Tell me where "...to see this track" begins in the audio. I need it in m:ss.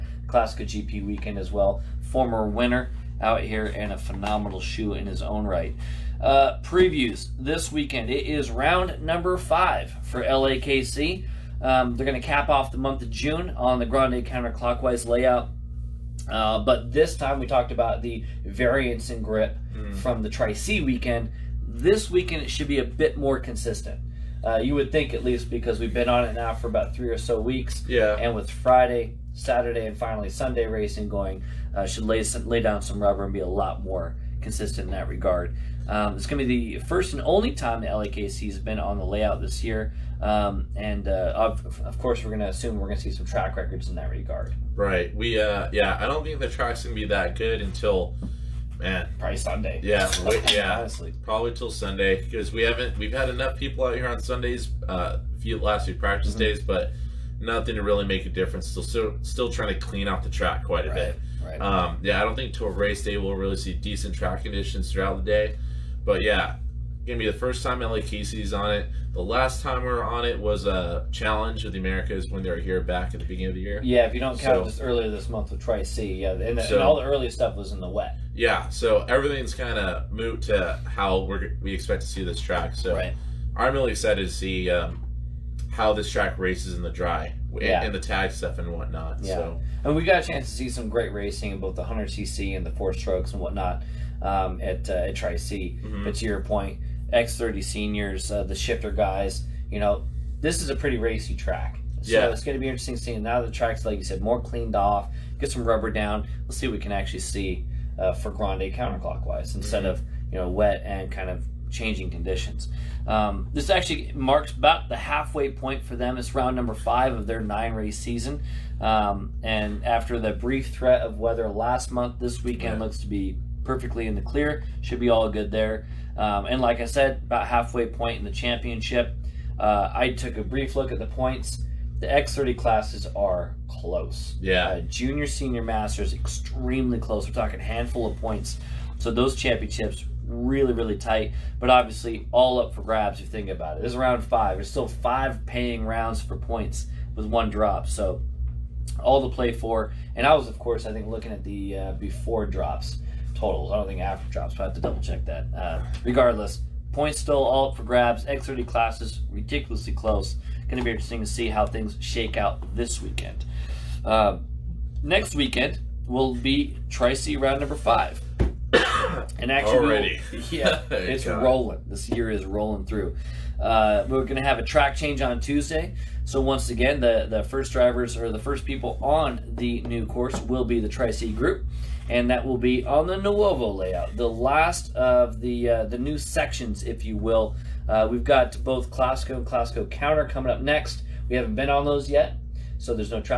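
1:22.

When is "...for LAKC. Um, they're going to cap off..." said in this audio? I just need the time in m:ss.
0:10.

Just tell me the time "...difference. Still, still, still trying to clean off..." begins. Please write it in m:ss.
0:58.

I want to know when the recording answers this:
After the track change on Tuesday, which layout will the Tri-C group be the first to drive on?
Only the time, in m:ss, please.
3:03.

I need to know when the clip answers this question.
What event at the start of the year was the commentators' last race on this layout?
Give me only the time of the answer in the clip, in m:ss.
1:11.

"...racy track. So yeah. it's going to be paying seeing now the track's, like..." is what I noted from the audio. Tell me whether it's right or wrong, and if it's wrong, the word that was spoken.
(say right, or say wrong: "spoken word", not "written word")
wrong: "interesting", not "paying".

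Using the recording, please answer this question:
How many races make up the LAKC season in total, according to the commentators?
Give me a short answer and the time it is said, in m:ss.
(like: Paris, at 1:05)
9, at 1:57.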